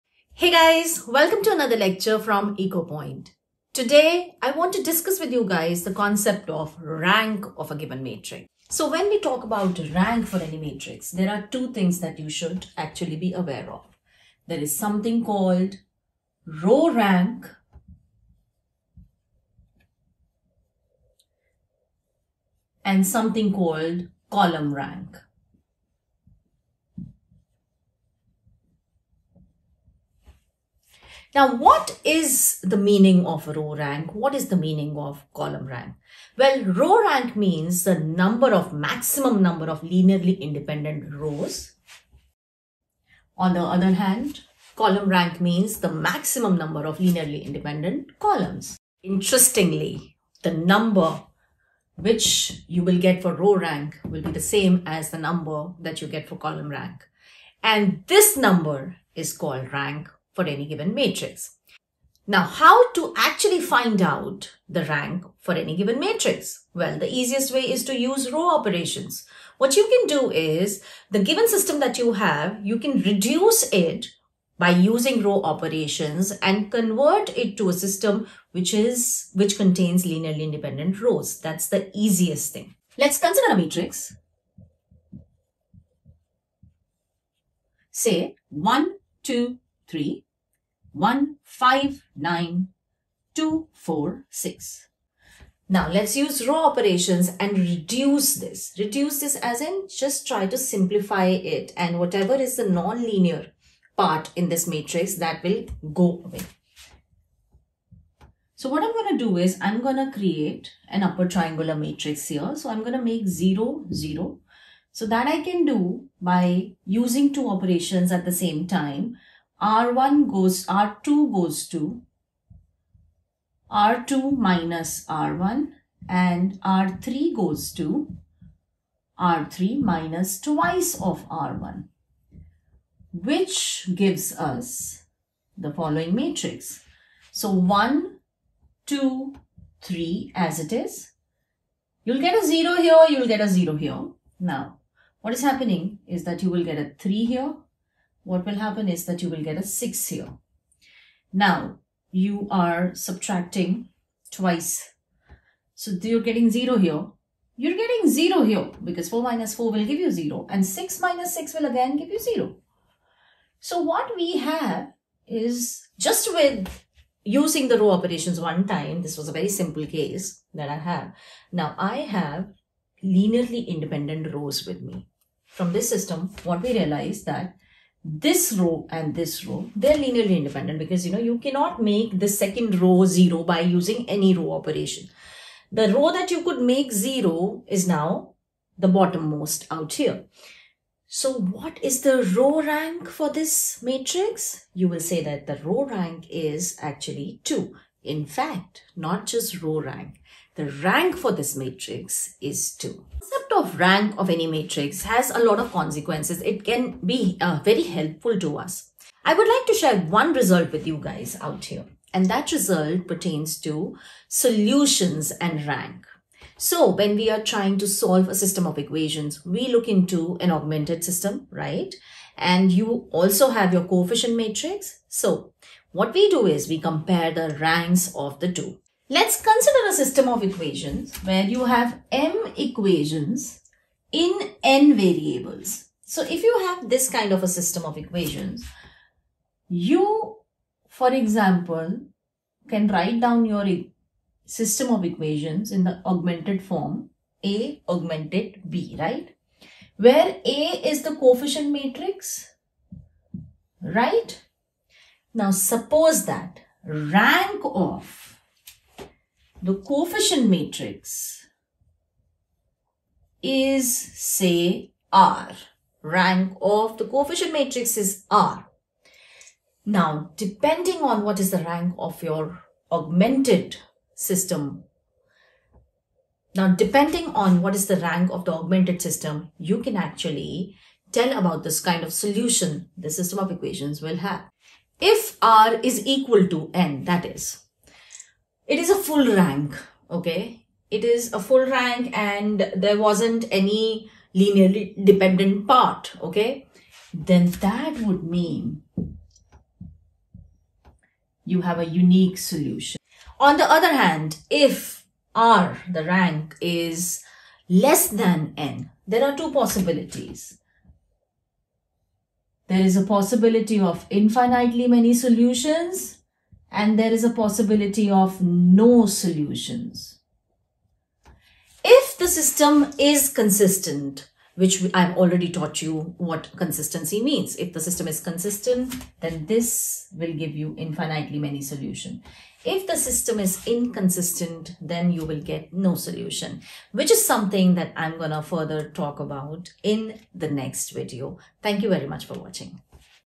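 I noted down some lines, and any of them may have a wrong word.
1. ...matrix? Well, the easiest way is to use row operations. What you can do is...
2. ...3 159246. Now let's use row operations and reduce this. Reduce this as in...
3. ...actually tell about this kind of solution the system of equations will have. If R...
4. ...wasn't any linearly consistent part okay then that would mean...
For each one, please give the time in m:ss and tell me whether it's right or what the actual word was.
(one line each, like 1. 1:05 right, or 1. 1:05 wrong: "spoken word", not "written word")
1. 1:05 right
2. 1:29 right
3. 4:39 right
4. 4:52 wrong: "dependent", not "consistent".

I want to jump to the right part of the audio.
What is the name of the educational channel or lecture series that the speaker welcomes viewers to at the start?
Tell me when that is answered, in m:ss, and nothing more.
0:02.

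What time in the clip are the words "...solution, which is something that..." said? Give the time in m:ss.
5:35.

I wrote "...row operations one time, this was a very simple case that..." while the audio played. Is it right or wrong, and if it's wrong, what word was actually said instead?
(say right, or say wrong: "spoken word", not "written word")
right.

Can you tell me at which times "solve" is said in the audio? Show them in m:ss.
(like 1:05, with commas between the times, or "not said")
3:37.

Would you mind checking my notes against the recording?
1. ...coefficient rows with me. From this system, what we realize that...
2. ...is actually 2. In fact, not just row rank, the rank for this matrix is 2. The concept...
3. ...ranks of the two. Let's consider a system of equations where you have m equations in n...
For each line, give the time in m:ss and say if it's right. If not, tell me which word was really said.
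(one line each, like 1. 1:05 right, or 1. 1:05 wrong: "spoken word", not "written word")
1. 2:53 wrong: "independent", not "coefficient"
2. 3:16 right
3. 3:47 right.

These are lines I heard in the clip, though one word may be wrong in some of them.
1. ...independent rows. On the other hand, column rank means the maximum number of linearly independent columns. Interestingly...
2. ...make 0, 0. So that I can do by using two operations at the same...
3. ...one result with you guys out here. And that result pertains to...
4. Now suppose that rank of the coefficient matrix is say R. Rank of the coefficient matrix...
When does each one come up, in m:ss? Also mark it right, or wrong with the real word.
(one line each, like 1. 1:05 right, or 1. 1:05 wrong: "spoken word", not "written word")
1. 0:40 right
2. 1:53 right
3. 3:30 right
4. 4:15 right.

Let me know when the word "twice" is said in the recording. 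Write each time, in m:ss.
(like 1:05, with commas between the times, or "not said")
2:10, 2:34.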